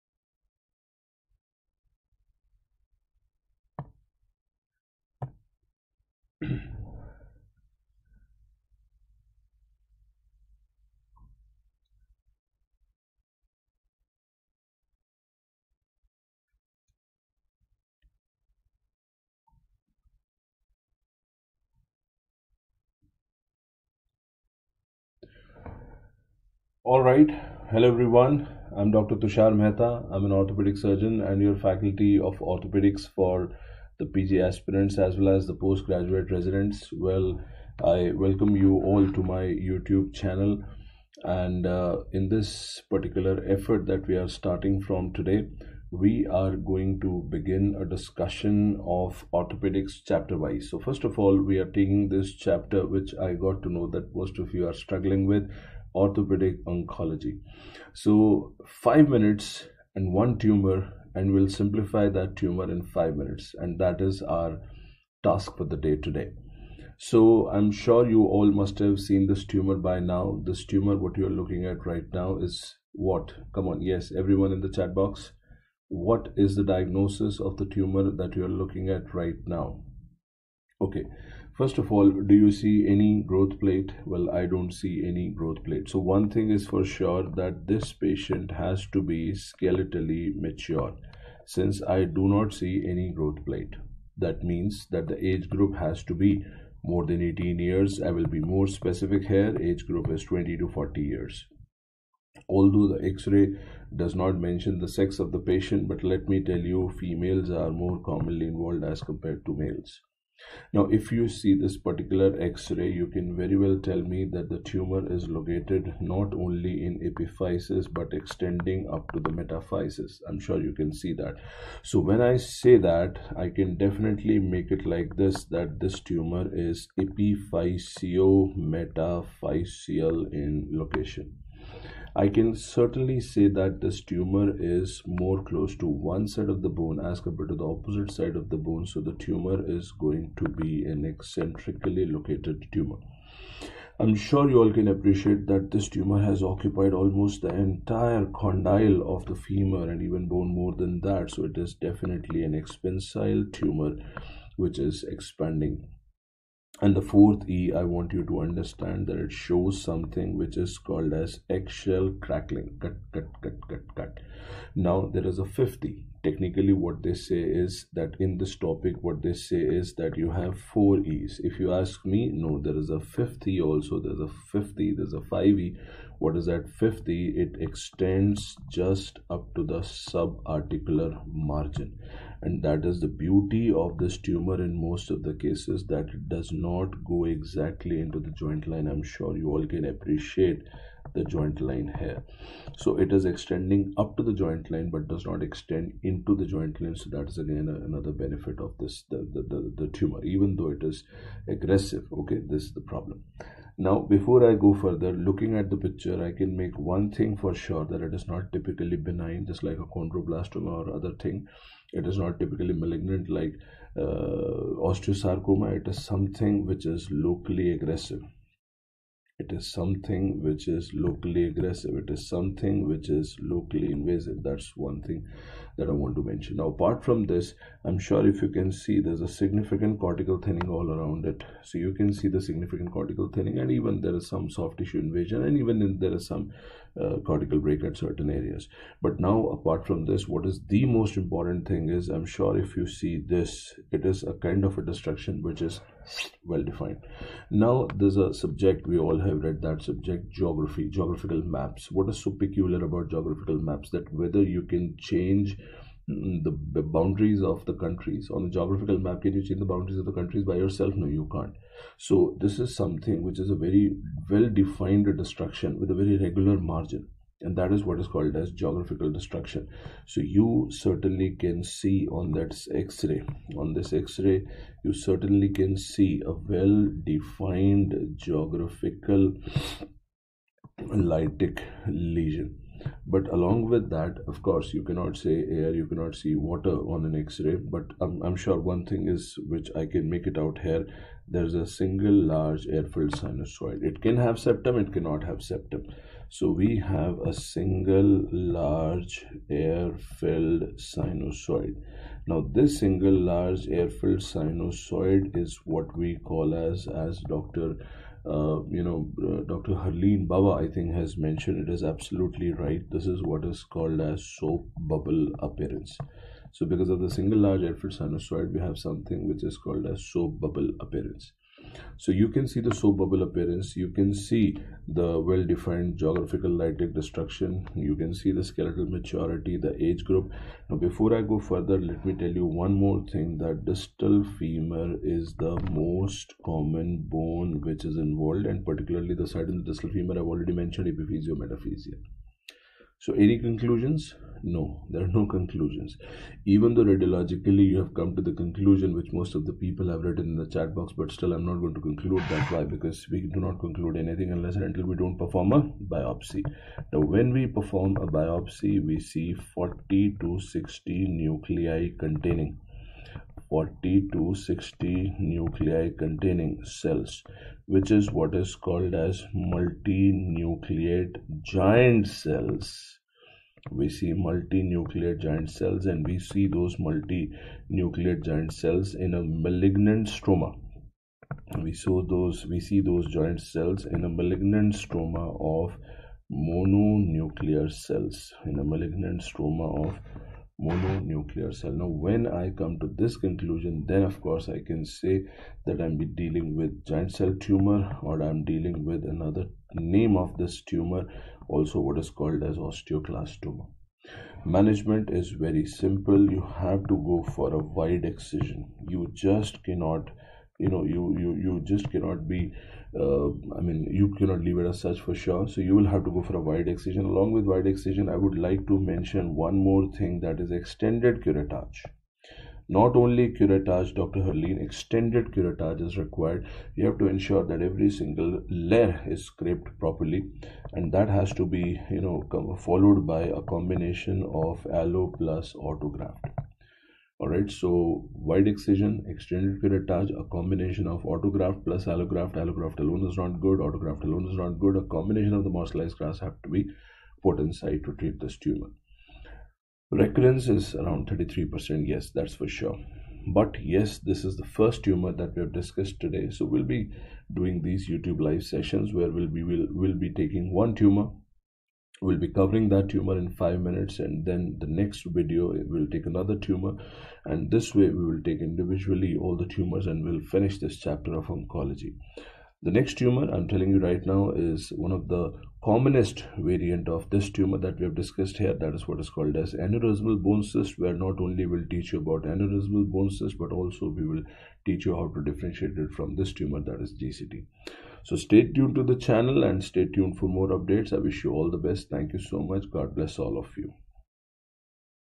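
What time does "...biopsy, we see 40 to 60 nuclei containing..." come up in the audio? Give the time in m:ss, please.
5:58.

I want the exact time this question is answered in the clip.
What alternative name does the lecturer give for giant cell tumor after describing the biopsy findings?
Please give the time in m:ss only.
6:42.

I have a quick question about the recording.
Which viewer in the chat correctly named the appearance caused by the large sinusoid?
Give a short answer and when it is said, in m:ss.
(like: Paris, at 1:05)
Dr. Harleen Baba, at 5:09.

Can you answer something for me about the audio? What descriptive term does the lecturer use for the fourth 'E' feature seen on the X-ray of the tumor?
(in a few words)
Eggshell crackling.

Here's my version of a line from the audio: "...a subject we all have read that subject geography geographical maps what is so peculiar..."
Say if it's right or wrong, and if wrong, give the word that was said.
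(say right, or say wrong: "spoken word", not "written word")
right.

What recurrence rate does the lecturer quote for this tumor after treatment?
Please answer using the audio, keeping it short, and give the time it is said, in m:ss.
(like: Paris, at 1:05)
33%, at 7:31.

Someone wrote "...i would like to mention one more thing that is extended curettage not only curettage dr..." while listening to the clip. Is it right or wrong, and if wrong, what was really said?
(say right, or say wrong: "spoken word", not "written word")
right.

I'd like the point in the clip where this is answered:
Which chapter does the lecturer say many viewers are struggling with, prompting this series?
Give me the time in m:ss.
0:55.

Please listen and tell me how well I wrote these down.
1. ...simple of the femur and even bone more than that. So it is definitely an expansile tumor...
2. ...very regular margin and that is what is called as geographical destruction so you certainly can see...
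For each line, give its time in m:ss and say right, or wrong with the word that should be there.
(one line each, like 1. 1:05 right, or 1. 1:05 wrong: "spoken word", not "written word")
1. 2:28 wrong: "condyle", not "simple"
2. 4:26 right.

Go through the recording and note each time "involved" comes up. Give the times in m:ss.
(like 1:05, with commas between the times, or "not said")
1:48, 5:37.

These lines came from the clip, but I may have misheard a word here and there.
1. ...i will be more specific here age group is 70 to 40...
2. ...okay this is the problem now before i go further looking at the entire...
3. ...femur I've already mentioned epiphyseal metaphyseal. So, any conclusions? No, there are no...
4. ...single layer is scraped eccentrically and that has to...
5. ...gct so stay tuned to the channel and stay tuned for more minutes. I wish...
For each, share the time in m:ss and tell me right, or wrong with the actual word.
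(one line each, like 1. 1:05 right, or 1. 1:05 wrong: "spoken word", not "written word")
1. 1:38 wrong: "20", not "70"
2. 3:22 wrong: "picture", not "entire"
3. 5:39 right
4. 7:07 wrong: "properly", not "eccentrically"
5. 8:07 wrong: "updates", not "minutes".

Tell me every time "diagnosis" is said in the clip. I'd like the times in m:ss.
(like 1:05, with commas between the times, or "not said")
1:16.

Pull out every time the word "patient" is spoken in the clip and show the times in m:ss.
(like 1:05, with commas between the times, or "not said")
1:28, 1:45.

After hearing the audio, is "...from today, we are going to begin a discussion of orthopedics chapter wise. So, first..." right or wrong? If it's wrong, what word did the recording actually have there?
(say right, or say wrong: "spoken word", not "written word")
right.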